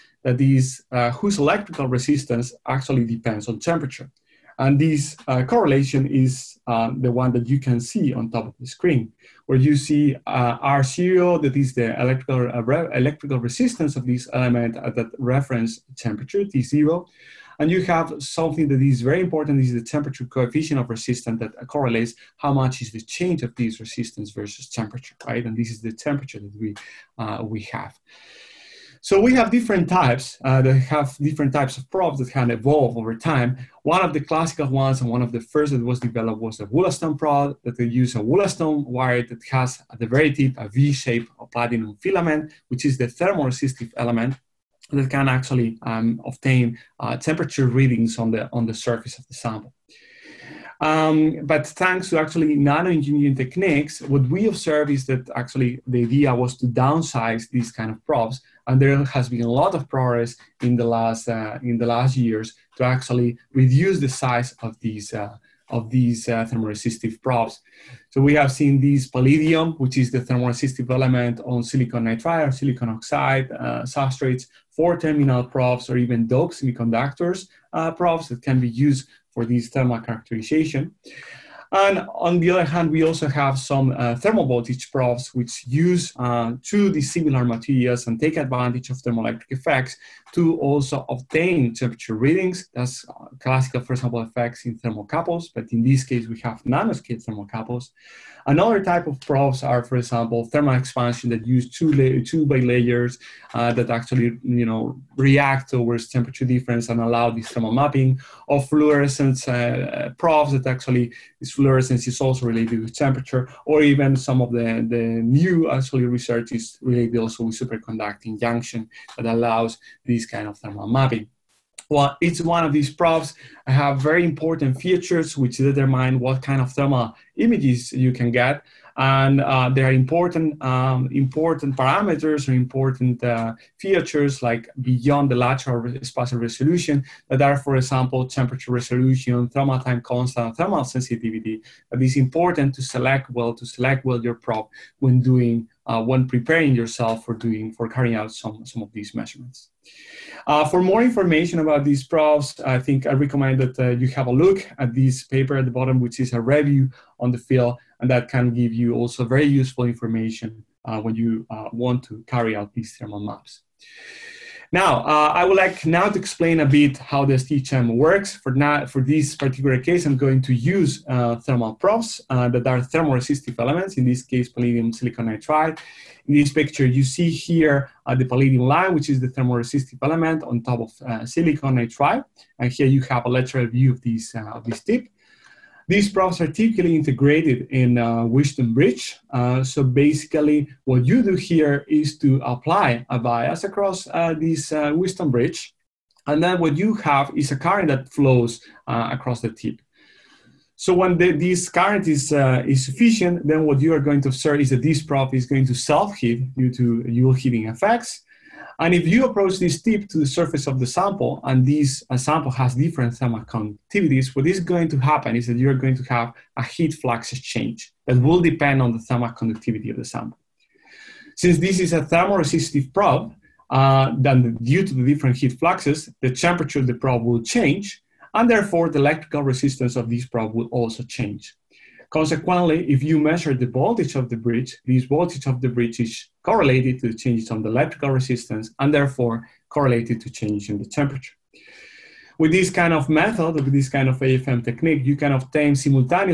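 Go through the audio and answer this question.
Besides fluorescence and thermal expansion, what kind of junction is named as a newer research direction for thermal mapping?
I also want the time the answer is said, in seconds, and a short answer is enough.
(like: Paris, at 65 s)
superconducting junction, at 117 s.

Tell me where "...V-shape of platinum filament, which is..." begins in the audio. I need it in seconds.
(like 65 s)
40 s.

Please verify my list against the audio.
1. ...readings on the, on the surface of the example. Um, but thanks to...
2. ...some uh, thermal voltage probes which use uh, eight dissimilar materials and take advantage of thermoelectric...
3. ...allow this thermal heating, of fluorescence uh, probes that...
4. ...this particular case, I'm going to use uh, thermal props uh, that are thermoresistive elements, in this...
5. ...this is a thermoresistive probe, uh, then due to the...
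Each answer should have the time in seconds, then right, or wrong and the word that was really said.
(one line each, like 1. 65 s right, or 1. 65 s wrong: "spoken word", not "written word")
1. 47 s wrong: "sample", not "example"
2. 83 s wrong: "two", not "eight"
3. 106 s wrong: "mapping", not "heating"
4. 169 s right
5. 221 s right.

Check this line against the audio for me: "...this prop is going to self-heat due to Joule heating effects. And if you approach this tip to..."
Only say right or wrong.
right.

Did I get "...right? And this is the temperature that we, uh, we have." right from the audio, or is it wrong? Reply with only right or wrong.
right.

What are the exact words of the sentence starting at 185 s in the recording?
These props are typically integrated in uh, Wheatstone Bridge.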